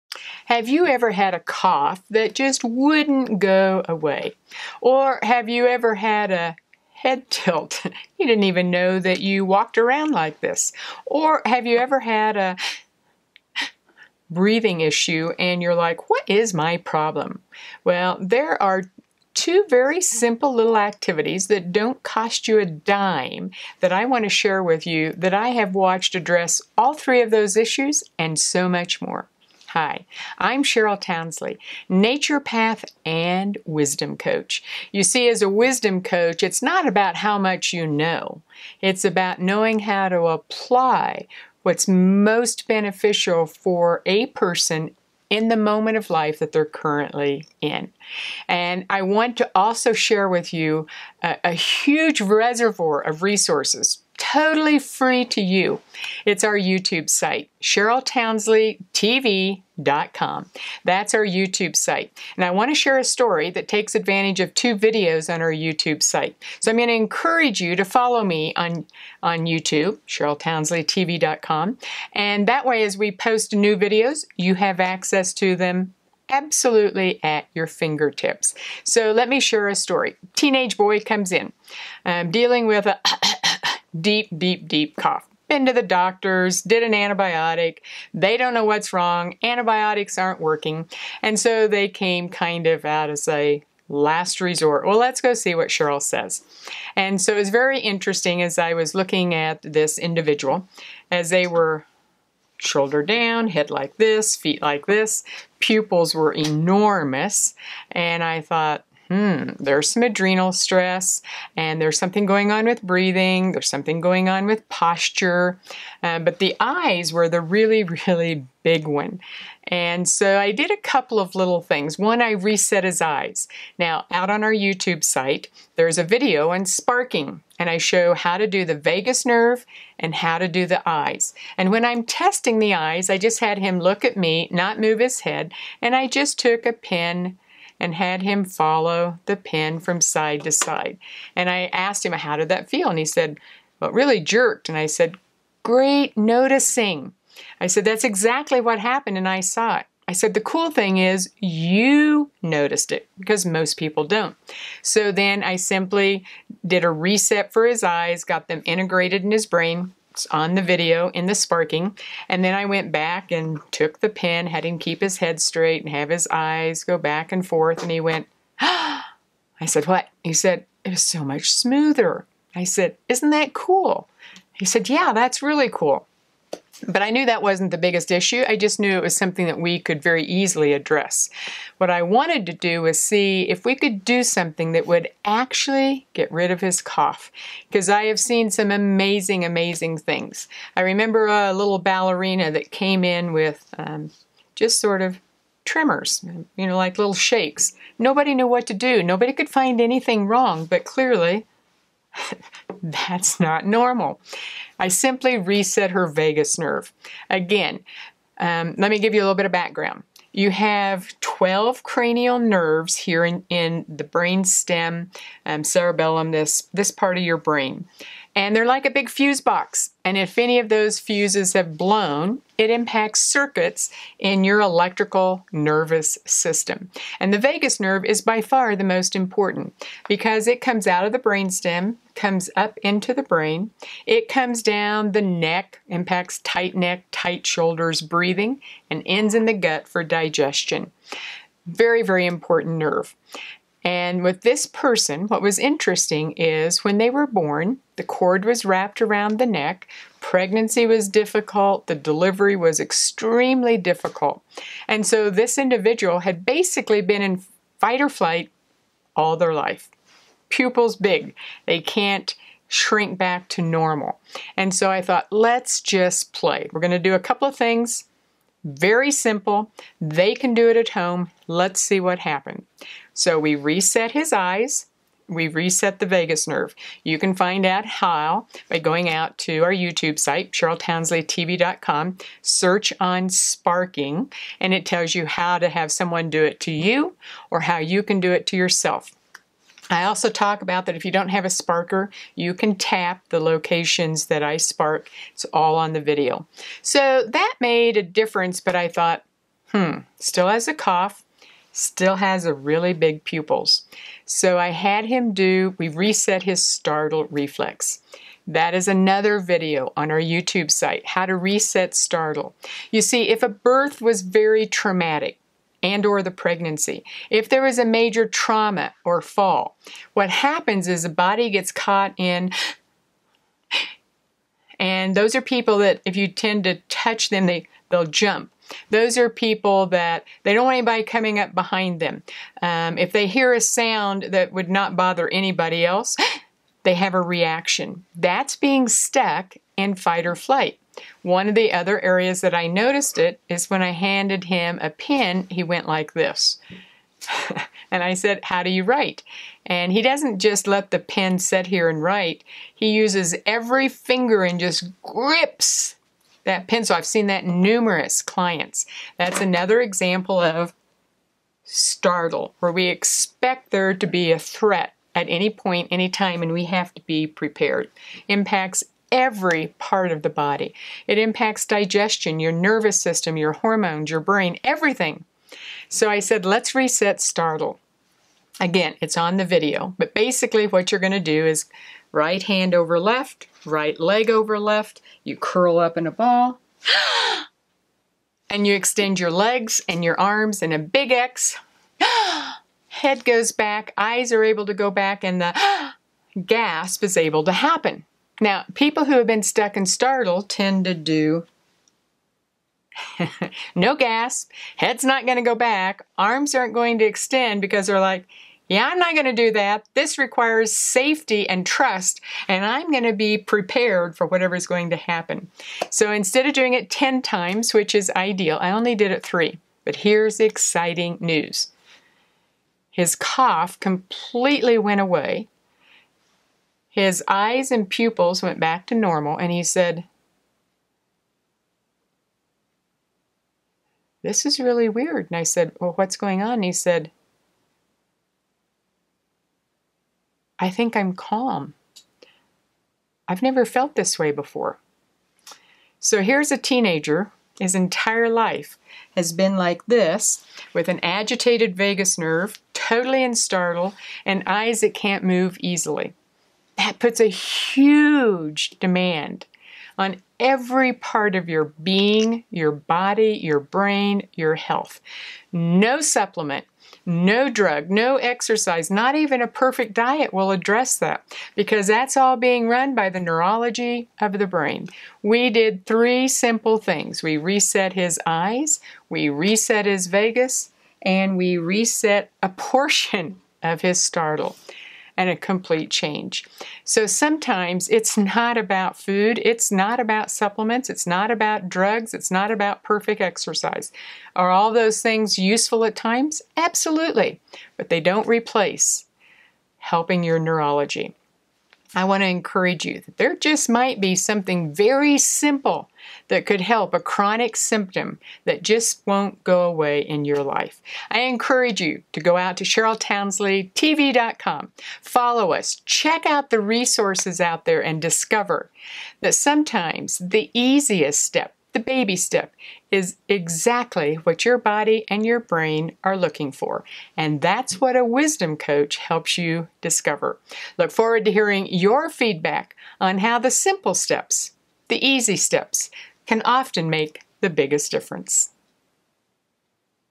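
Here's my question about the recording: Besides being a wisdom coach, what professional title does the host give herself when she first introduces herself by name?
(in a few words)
naturopath.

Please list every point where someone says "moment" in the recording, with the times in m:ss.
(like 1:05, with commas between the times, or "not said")
0:45.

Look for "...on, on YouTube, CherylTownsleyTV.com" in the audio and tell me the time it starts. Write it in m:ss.
1:08.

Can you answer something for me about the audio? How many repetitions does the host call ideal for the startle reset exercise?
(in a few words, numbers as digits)
10 times.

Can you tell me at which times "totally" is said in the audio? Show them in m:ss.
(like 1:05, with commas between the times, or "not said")
0:54, 7:32.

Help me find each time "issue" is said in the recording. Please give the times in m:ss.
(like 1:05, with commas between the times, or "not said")
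0:14, 0:27, 2:58.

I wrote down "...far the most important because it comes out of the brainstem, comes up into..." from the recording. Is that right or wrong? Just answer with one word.
right.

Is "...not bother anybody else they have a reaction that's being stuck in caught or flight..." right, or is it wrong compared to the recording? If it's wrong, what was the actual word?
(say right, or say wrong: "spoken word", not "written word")
wrong: "fight", not "caught".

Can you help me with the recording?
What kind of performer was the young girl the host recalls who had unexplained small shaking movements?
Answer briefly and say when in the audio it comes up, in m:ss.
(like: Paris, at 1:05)
ballerina, at 3:11.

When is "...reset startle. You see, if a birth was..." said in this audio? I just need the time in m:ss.
5:11.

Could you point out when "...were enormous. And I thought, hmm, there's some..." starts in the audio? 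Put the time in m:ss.
1:46.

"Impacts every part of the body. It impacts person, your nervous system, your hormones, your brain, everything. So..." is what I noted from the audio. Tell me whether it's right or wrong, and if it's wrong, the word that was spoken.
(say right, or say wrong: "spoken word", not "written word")
wrong: "digestion", not "person".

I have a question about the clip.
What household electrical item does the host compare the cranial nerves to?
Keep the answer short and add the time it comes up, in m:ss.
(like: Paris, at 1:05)
a big fuse box, at 3:38.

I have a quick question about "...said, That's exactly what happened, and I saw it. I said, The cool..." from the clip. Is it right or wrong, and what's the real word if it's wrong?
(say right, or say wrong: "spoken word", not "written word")
right.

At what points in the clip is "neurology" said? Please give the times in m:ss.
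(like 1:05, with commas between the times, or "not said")
7:53, 8:20.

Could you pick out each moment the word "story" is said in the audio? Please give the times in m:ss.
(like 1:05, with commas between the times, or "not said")
1:03, 1:19.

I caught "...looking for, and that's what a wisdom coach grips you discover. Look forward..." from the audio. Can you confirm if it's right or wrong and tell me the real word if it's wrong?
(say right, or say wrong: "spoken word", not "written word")
wrong: "helps", not "grips".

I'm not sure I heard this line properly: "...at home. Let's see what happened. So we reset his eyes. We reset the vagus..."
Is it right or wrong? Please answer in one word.
right.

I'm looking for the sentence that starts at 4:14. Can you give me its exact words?
And so this individual had basically been in fight or flight all their life.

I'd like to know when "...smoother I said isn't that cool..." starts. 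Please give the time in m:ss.
2:51.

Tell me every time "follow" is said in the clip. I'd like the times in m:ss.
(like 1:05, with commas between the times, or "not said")
1:07, 2:18, 8:35.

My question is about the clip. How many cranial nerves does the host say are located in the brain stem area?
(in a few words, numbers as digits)
12.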